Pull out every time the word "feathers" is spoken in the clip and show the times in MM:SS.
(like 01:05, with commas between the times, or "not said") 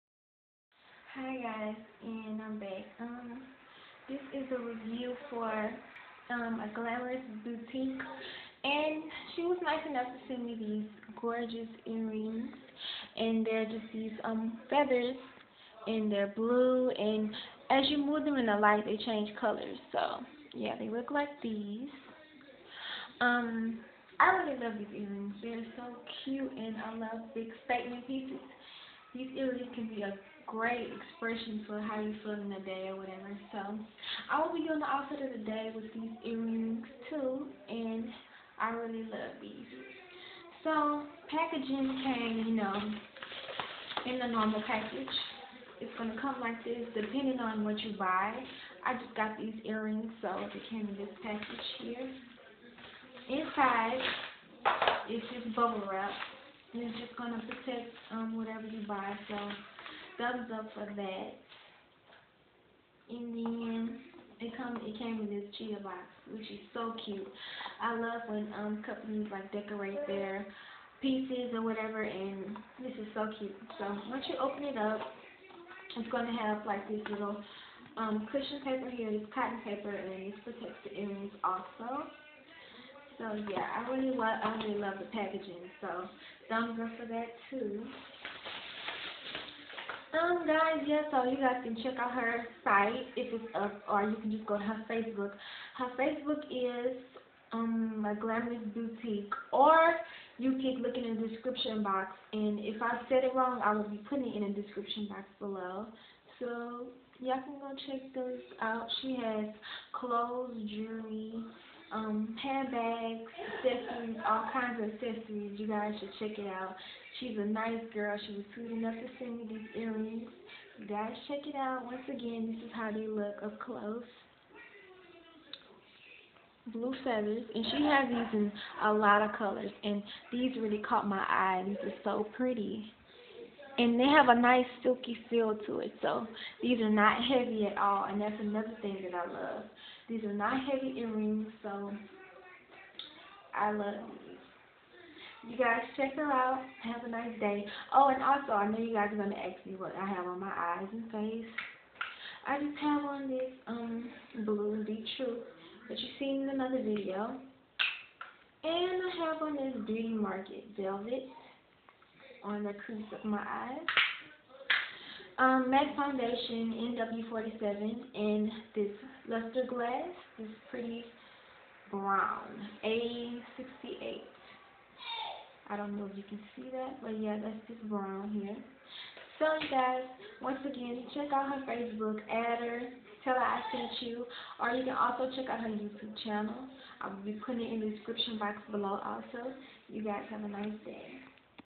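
00:14, 02:07.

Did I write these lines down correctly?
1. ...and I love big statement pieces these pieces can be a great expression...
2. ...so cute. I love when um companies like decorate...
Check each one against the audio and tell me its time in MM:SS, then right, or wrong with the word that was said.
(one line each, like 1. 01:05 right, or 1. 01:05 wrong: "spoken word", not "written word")
1. 00:26 wrong: "images", not "pieces"
2. 01:06 right.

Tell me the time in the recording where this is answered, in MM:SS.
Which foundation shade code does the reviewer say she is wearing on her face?
02:46.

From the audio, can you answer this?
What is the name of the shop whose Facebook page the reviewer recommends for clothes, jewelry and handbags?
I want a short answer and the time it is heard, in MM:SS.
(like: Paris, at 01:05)
My Glamorous Boutique, at 01:38.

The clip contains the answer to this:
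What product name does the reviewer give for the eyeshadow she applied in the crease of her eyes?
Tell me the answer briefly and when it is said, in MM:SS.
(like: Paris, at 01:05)
Beauty Marked Velvet, at 02:39.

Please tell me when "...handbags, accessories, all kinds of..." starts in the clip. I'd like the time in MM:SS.
01:52.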